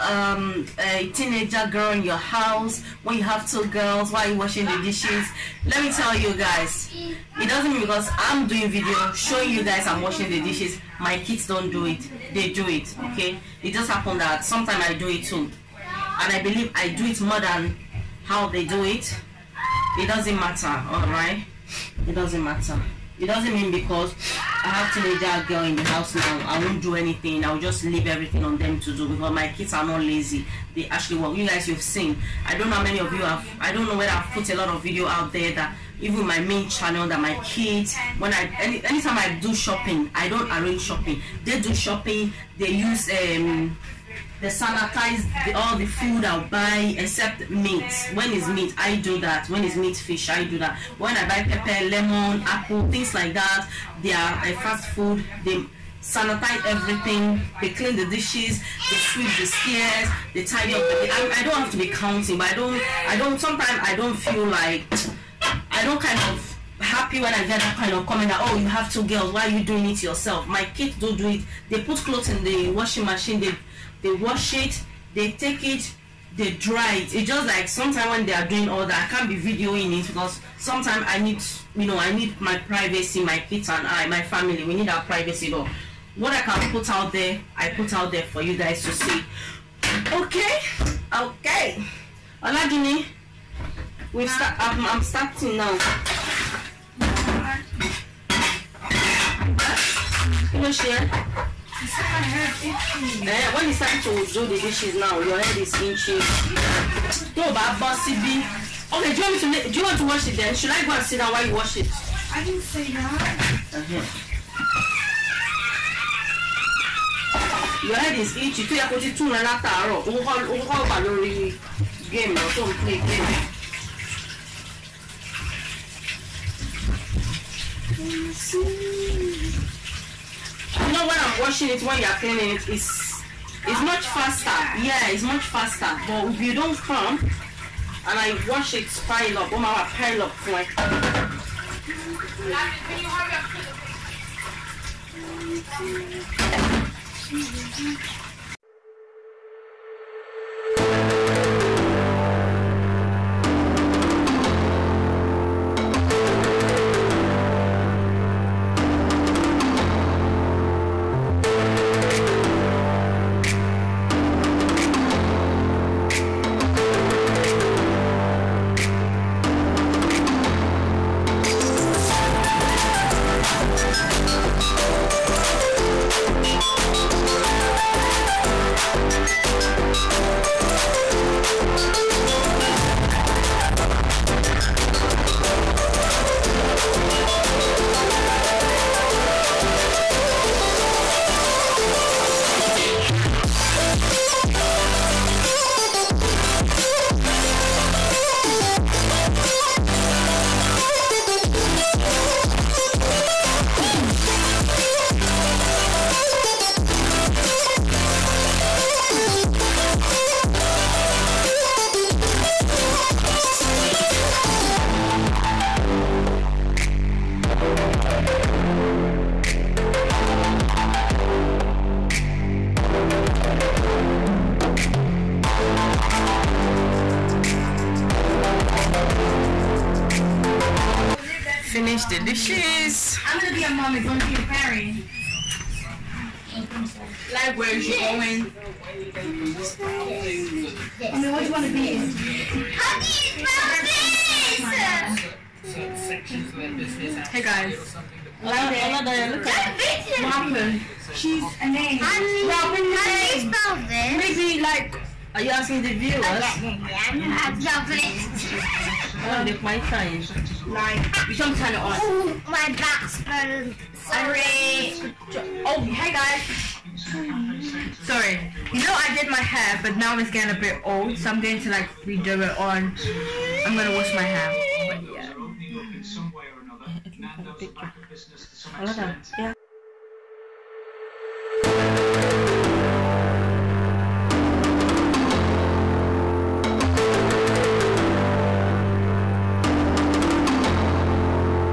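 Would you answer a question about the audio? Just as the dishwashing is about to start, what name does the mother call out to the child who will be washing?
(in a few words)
Jenny.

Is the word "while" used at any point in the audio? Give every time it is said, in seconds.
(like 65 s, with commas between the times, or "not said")
4 s, 111 s.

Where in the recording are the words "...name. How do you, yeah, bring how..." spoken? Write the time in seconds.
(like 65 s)
251 s.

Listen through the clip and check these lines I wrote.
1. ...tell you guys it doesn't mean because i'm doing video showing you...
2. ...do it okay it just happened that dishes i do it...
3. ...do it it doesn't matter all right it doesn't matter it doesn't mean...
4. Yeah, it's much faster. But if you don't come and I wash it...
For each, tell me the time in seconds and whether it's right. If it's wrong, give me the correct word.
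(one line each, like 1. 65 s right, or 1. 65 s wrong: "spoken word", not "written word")
1. 5 s right
2. 12 s wrong: "sometimes", not "dishes"
3. 18 s right
4. 134 s right.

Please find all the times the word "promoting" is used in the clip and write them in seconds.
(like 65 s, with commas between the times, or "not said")
not said.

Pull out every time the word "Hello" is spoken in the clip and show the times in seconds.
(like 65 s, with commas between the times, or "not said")
100 s, 248 s.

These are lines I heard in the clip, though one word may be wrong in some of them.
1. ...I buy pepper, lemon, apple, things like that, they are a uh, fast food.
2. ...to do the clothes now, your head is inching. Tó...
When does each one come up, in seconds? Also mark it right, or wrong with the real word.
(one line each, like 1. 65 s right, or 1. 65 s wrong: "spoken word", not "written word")
1. 51 s right
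2. 104 s wrong: "dishes", not "clothes".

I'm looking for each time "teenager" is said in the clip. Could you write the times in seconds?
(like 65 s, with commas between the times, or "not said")
1 s, 24 s.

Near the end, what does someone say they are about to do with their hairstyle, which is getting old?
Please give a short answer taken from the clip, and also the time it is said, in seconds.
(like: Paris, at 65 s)
wash my hair, at 273 s.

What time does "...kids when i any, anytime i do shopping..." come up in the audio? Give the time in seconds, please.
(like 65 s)
37 s.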